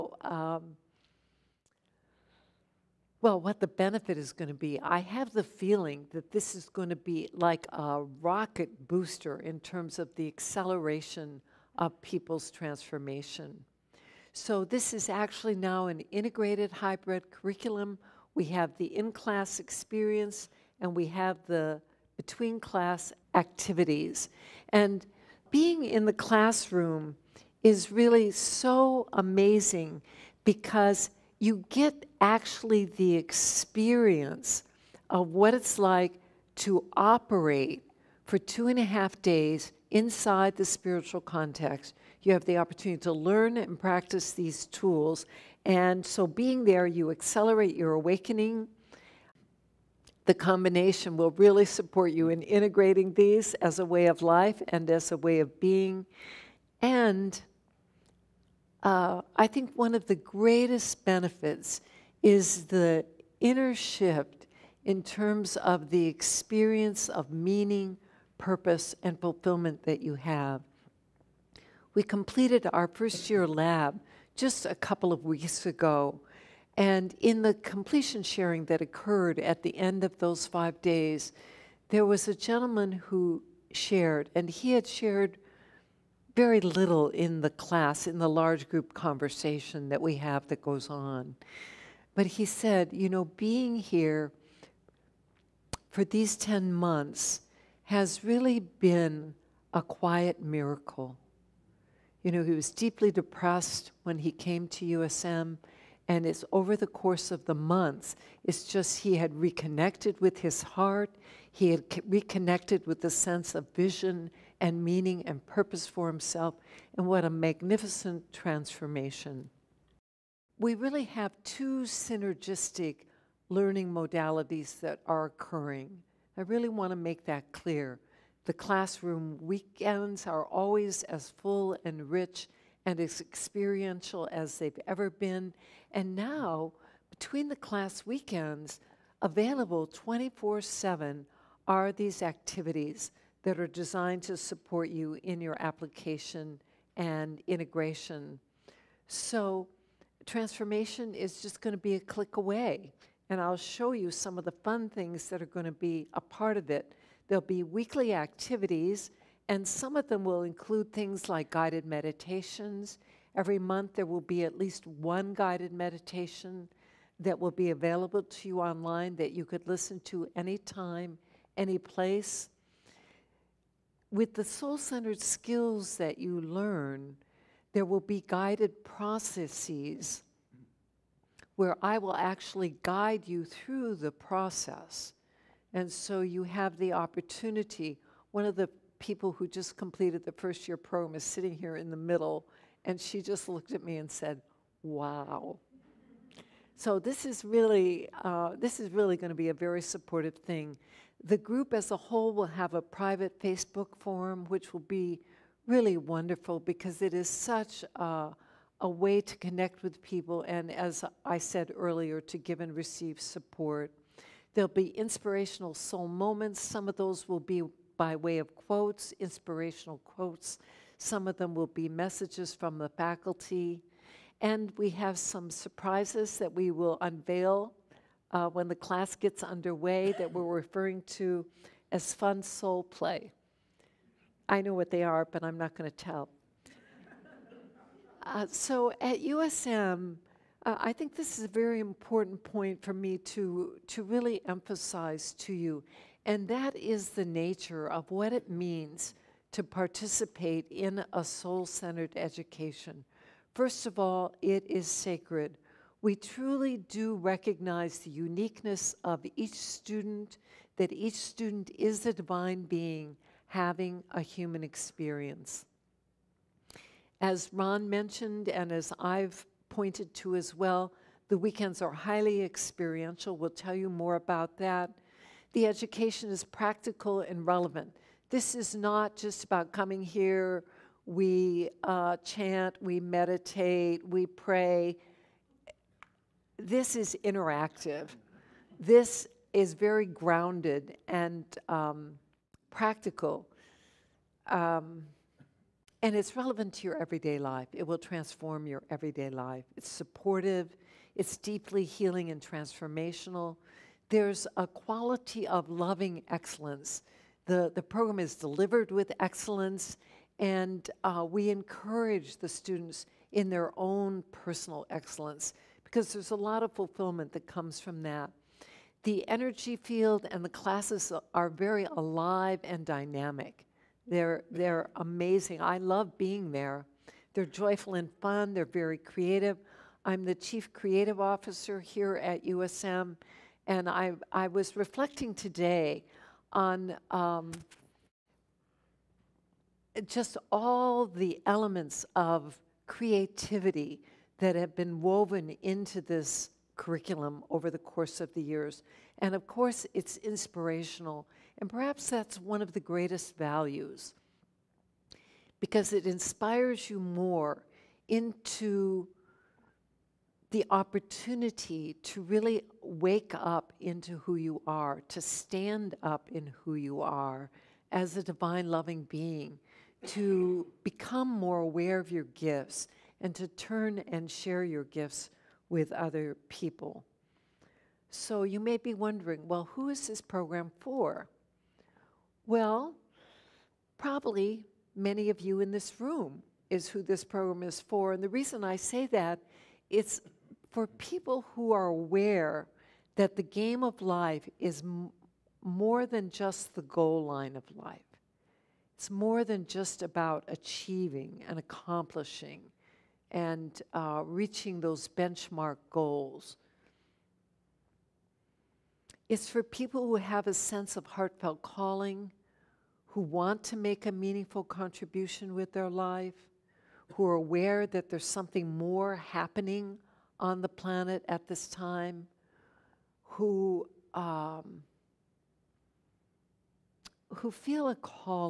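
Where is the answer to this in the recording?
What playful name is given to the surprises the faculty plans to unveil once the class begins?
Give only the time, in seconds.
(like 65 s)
232 s.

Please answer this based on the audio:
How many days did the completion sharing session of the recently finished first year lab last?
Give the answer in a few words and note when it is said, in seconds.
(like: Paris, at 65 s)
5, at 80 s.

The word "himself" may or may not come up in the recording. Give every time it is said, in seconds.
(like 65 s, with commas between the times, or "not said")
116 s.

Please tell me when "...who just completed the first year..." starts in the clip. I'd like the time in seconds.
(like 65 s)
189 s.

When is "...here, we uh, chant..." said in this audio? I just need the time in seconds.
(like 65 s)
280 s.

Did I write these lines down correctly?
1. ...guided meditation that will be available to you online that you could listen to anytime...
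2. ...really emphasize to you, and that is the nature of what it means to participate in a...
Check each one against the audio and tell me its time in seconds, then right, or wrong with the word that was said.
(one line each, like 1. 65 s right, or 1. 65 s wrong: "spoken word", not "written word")
1. 165 s right
2. 244 s right.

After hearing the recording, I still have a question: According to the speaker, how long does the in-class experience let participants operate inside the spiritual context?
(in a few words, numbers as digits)
2.5 days.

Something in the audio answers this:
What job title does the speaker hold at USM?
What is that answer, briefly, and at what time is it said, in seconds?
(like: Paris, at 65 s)
chief creative officer, at 330 s.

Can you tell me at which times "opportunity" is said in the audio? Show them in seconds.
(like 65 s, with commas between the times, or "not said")
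42 s, 186 s, 360 s.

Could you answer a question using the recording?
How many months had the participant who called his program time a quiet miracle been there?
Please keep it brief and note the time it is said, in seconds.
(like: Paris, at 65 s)
10 months, at 96 s.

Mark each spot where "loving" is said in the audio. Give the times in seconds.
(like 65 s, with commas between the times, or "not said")
305 s, 368 s.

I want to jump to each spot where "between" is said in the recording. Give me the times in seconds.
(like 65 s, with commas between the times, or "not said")
22 s, 137 s.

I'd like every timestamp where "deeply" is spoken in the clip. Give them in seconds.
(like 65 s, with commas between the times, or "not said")
102 s, 301 s.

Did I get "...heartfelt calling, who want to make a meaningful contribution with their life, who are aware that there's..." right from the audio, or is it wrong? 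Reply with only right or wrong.
right.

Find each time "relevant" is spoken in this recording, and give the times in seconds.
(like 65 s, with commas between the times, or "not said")
277 s, 296 s.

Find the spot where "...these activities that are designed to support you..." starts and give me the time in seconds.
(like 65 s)
141 s.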